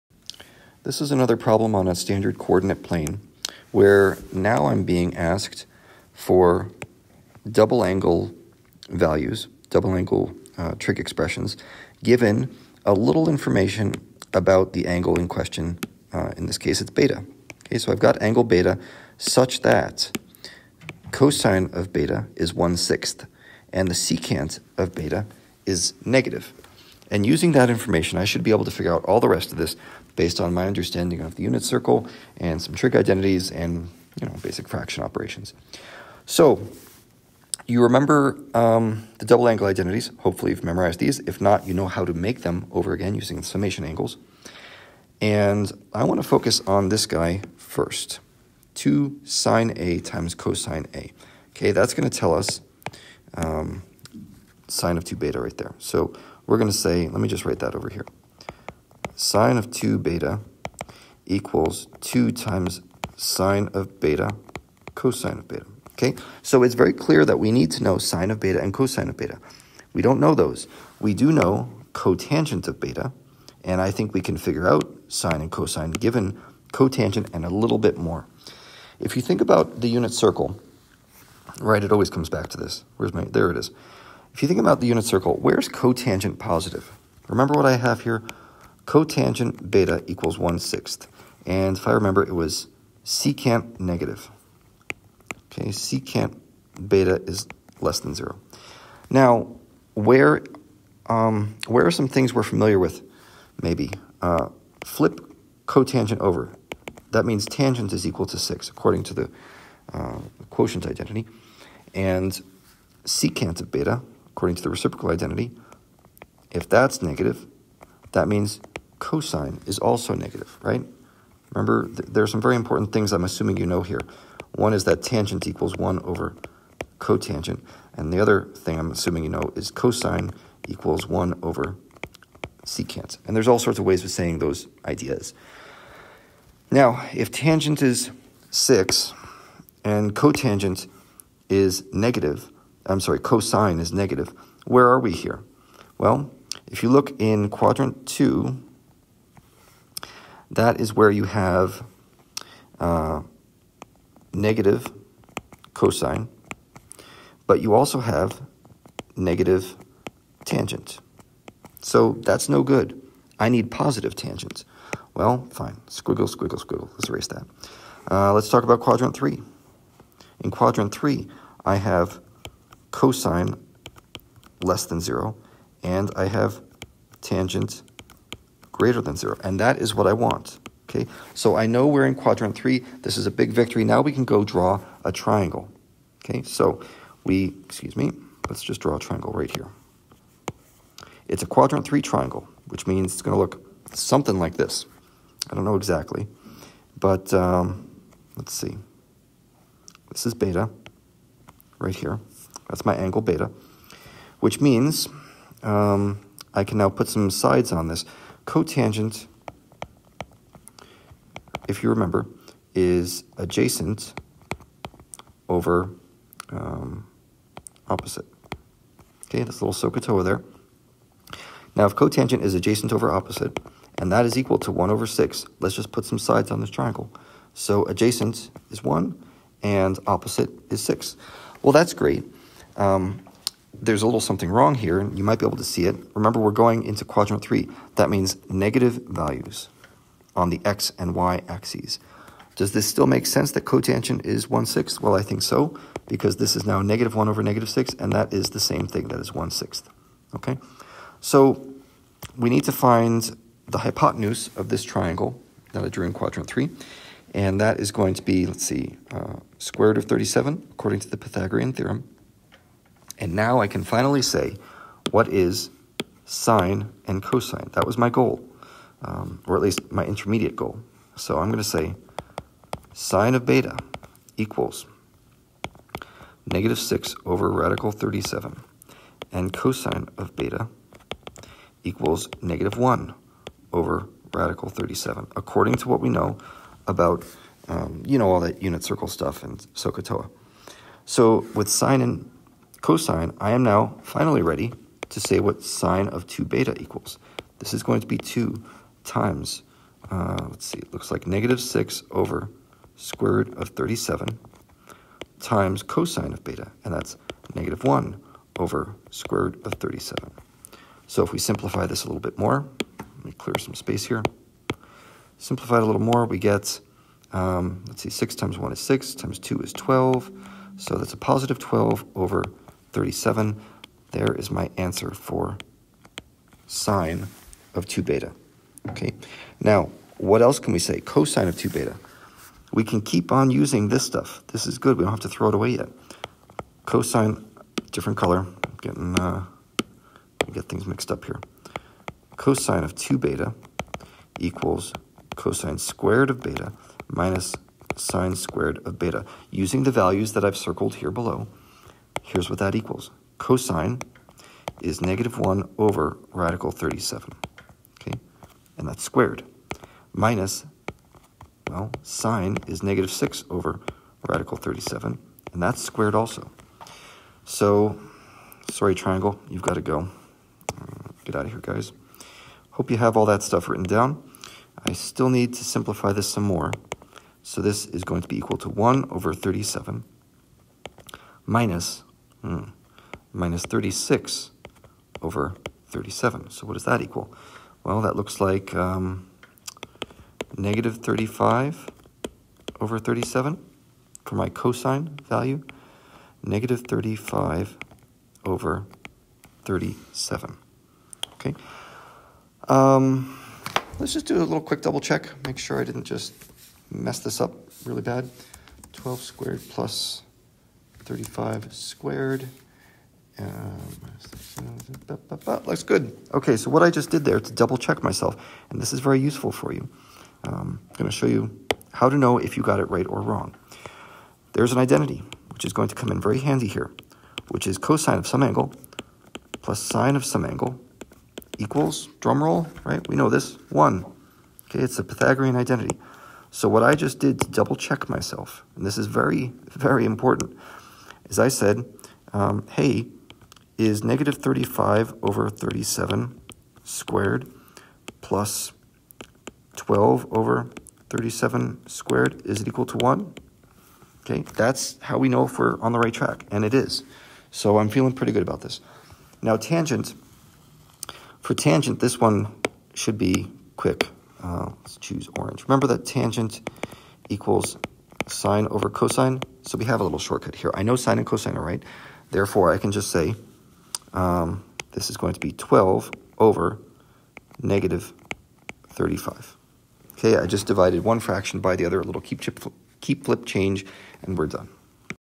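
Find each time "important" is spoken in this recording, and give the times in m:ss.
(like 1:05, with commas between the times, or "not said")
2:02, 7:20.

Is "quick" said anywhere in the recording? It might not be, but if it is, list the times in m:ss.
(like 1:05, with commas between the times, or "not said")
6:44, 7:43.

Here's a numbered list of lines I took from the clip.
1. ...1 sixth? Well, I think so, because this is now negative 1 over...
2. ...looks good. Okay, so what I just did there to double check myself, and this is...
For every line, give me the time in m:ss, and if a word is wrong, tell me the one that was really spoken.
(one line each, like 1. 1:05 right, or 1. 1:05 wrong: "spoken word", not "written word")
1. 4:04 right
2. 6:55 right.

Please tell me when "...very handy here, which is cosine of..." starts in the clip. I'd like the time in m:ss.
7:06.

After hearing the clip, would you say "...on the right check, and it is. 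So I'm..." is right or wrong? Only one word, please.
wrong.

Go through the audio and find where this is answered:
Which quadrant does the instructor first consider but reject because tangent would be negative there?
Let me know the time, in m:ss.
2:27.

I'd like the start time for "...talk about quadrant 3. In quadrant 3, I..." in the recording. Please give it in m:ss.
2:48.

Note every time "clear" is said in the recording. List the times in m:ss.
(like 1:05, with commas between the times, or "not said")
1:06, 5:13.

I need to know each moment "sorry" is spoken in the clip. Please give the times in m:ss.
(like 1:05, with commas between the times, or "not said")
2:23, 6:08.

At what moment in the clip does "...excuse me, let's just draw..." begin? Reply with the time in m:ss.
3:07.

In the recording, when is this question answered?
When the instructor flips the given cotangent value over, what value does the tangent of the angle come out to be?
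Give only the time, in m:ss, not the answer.
1:47.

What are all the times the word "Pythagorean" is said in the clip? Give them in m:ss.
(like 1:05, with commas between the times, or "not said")
4:21, 7:15.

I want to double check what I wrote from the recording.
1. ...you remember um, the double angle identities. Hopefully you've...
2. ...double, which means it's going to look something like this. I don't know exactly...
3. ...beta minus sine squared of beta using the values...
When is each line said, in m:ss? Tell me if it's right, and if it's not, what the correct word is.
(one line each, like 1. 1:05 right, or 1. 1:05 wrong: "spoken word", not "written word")
1. 0:37 right
2. 3:12 wrong: "triangle", not "double"
3. 5:46 right.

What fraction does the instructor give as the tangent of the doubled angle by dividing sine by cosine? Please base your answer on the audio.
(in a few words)
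12/-35.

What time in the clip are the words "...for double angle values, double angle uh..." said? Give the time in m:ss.
0:06.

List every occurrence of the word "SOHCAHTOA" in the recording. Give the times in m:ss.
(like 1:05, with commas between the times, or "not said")
3:39, 4:49.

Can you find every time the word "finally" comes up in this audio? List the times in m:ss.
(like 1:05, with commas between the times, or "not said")
4:23, 4:54.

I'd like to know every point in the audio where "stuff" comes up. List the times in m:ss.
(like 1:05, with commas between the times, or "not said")
4:49, 5:34, 6:13.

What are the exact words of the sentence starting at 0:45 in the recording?
And I want to focus on this guy first.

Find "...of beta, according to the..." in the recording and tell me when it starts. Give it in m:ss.
1:53.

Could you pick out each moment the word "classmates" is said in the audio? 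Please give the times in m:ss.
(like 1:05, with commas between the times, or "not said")
not said.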